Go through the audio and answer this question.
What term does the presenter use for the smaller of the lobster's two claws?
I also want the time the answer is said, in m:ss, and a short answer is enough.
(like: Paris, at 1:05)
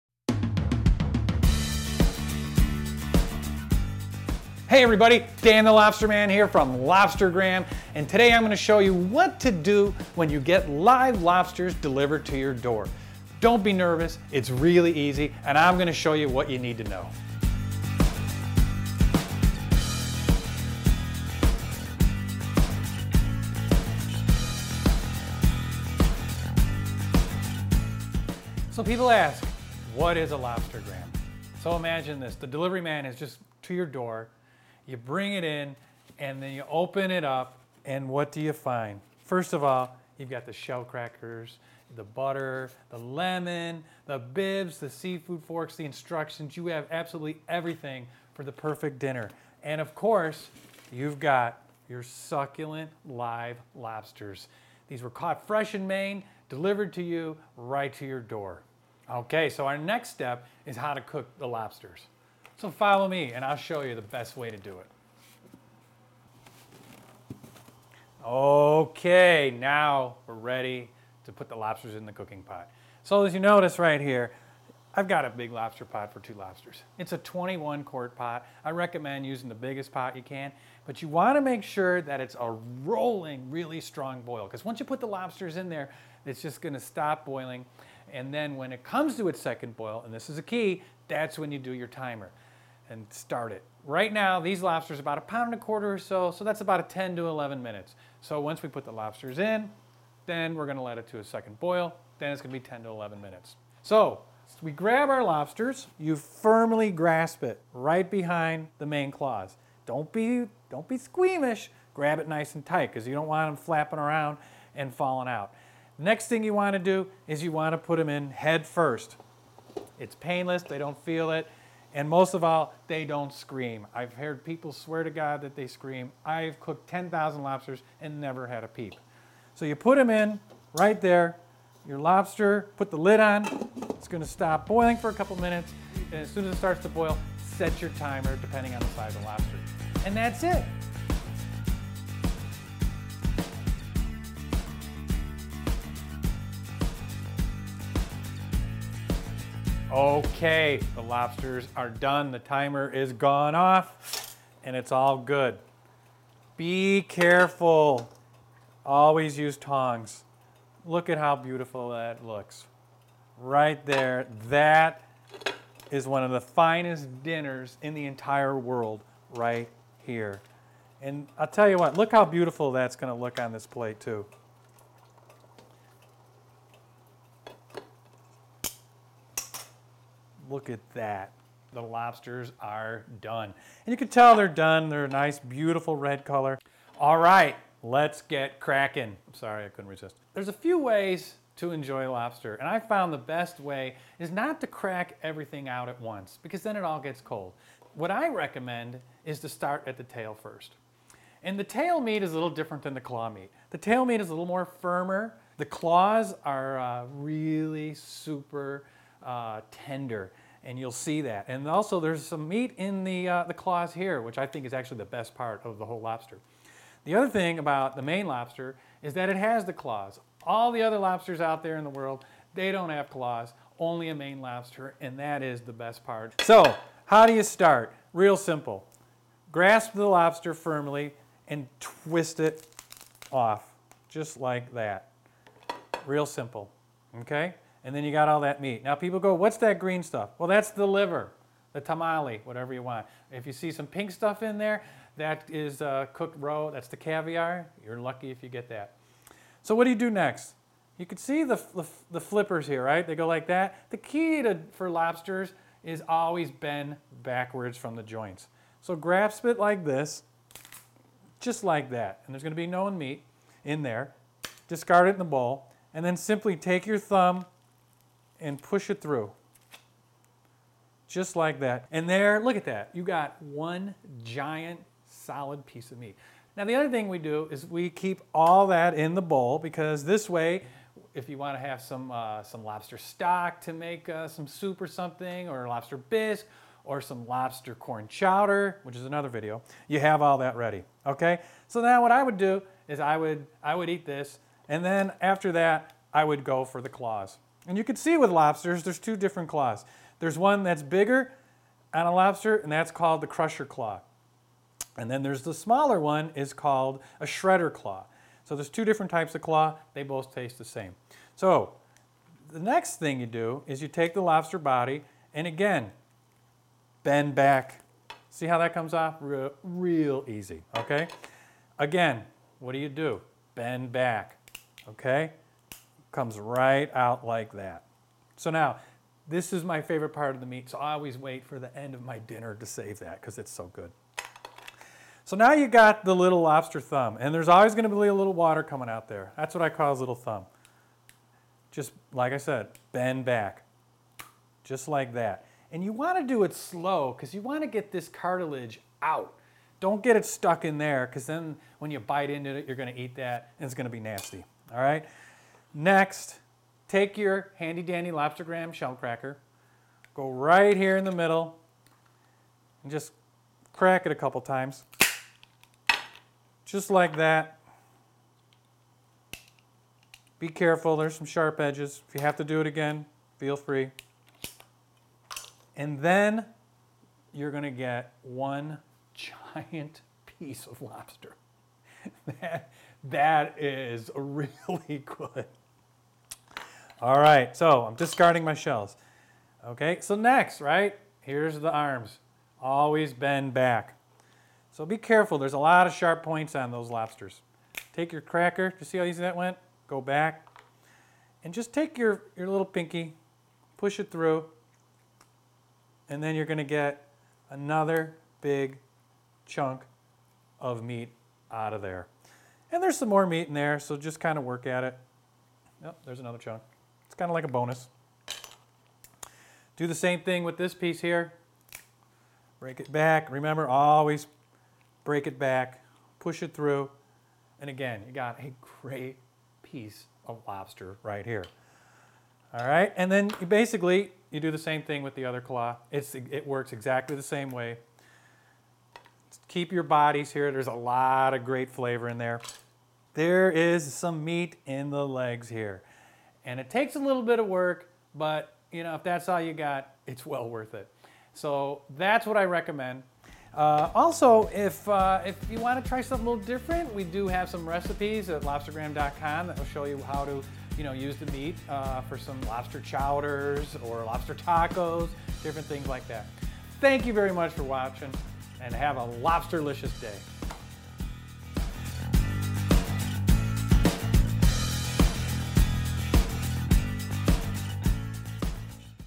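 shredder claw, at 5:07.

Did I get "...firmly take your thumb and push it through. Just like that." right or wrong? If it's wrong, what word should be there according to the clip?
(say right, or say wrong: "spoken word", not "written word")
wrong: "simply", not "firmly".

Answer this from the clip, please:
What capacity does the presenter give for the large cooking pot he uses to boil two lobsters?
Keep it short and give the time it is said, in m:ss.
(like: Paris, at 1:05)
21 quart, at 1:17.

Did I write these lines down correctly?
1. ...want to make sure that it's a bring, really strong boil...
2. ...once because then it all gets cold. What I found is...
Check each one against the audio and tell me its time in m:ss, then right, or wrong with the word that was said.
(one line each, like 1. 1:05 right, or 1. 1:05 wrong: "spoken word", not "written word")
1. 1:21 wrong: "rolling", not "bring"
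2. 3:16 wrong: "recommend", not "found".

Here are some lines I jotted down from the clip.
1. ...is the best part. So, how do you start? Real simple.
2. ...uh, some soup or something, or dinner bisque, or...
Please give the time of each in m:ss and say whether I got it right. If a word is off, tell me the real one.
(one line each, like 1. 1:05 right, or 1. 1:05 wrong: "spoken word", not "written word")
1. 3:45 right
2. 4:44 wrong: "lobster", not "dinner".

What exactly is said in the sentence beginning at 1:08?
Okay, now we're ready to put the lobsters in the cooking pot.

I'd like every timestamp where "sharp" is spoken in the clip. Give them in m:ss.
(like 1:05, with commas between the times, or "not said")
6:11, 6:35.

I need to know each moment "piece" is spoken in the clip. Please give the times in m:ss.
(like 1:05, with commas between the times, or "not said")
4:35, 6:20, 7:00, 7:09.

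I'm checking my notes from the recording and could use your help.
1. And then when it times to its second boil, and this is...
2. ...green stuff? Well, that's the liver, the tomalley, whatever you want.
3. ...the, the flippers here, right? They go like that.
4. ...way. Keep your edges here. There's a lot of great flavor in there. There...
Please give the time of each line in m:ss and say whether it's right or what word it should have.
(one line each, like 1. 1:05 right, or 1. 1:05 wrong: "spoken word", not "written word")
1. 1:28 wrong: "comes", not "times"
2. 3:59 right
3. 4:11 right
4. 7:17 wrong: "bodies", not "edges".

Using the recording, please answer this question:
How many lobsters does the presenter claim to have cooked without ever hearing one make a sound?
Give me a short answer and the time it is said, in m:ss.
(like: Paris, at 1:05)
10,000, at 2:06.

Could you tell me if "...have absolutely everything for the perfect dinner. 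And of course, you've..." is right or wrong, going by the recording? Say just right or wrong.
right.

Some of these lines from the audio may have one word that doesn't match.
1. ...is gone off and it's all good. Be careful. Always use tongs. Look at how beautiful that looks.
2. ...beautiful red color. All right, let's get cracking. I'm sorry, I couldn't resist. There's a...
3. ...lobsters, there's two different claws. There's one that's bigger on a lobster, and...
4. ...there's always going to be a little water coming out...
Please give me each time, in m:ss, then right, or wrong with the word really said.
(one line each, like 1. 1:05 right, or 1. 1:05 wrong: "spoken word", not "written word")
1. 2:32 right
2. 3:05 right
3. 4:58 right
4. 5:37 right.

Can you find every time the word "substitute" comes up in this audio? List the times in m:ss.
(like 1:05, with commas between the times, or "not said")
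not said.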